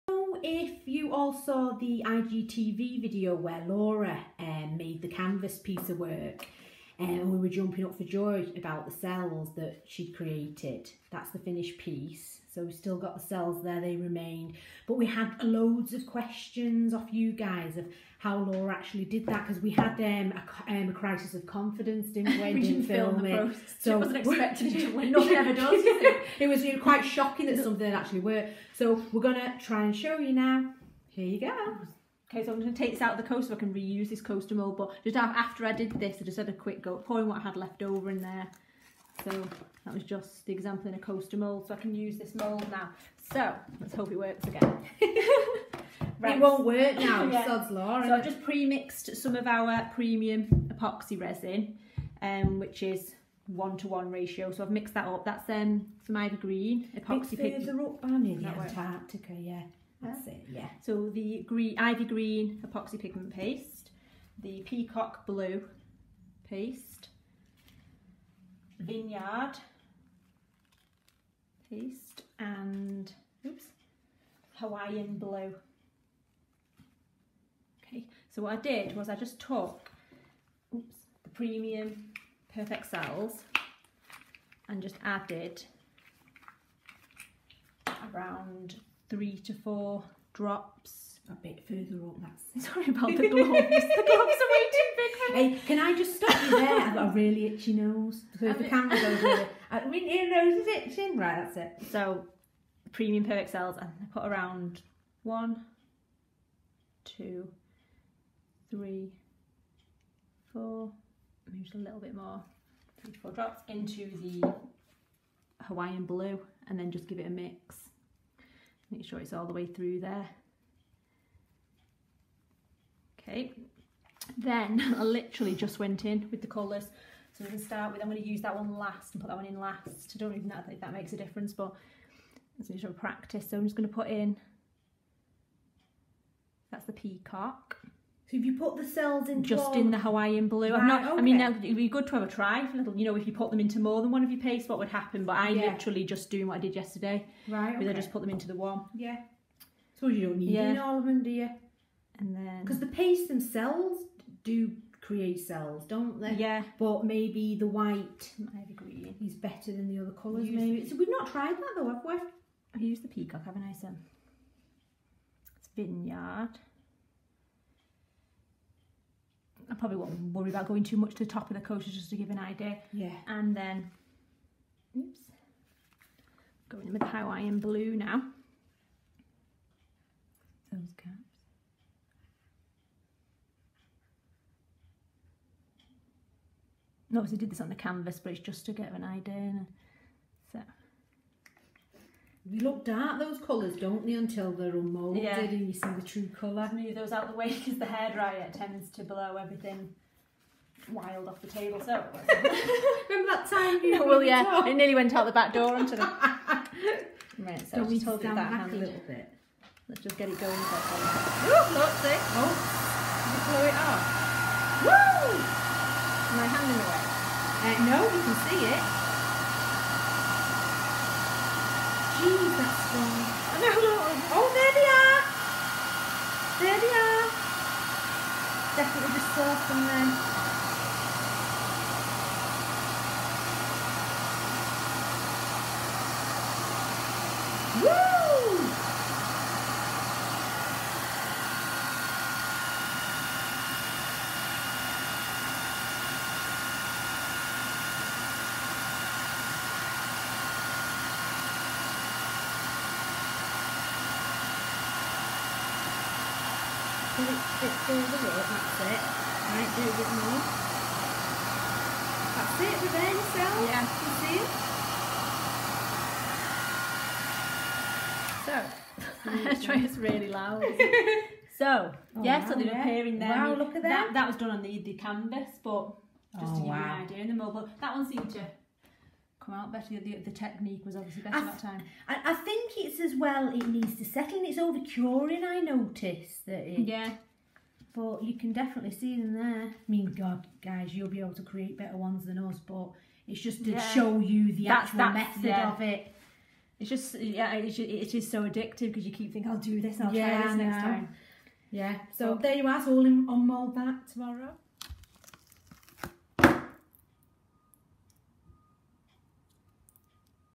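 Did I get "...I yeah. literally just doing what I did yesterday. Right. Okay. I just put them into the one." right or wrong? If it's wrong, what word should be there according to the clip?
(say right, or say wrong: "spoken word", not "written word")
right.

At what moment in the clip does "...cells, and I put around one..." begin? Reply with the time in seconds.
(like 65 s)
103 s.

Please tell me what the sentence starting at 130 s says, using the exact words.
I don't even know if that makes a difference, but it's a of practice.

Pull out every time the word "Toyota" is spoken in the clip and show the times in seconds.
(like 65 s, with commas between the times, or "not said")
not said.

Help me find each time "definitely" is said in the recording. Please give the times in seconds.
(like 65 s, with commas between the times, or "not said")
228 s, 288 s.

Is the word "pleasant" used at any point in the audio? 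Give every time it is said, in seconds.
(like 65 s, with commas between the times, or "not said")
not said.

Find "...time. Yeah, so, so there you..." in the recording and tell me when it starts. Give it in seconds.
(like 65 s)
300 s.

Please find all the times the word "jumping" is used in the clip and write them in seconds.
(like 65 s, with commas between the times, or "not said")
7 s.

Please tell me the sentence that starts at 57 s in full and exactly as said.
It's further up, in Antarctica, yeah.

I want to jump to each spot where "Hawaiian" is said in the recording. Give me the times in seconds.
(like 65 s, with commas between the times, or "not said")
74 s, 115 s, 139 s, 177 s.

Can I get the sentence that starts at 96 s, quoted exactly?
I've got a really itchy nose.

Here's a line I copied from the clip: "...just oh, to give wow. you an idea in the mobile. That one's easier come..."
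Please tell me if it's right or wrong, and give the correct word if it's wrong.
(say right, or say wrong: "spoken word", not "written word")
right.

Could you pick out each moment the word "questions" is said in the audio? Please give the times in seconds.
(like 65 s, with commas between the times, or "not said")
16 s.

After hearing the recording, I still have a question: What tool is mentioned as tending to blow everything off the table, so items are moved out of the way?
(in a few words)
Hairdryer.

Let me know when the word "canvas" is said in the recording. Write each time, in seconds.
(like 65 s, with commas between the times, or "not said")
5 s, 187 s, 274 s.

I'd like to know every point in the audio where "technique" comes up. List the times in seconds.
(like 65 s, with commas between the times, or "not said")
280 s.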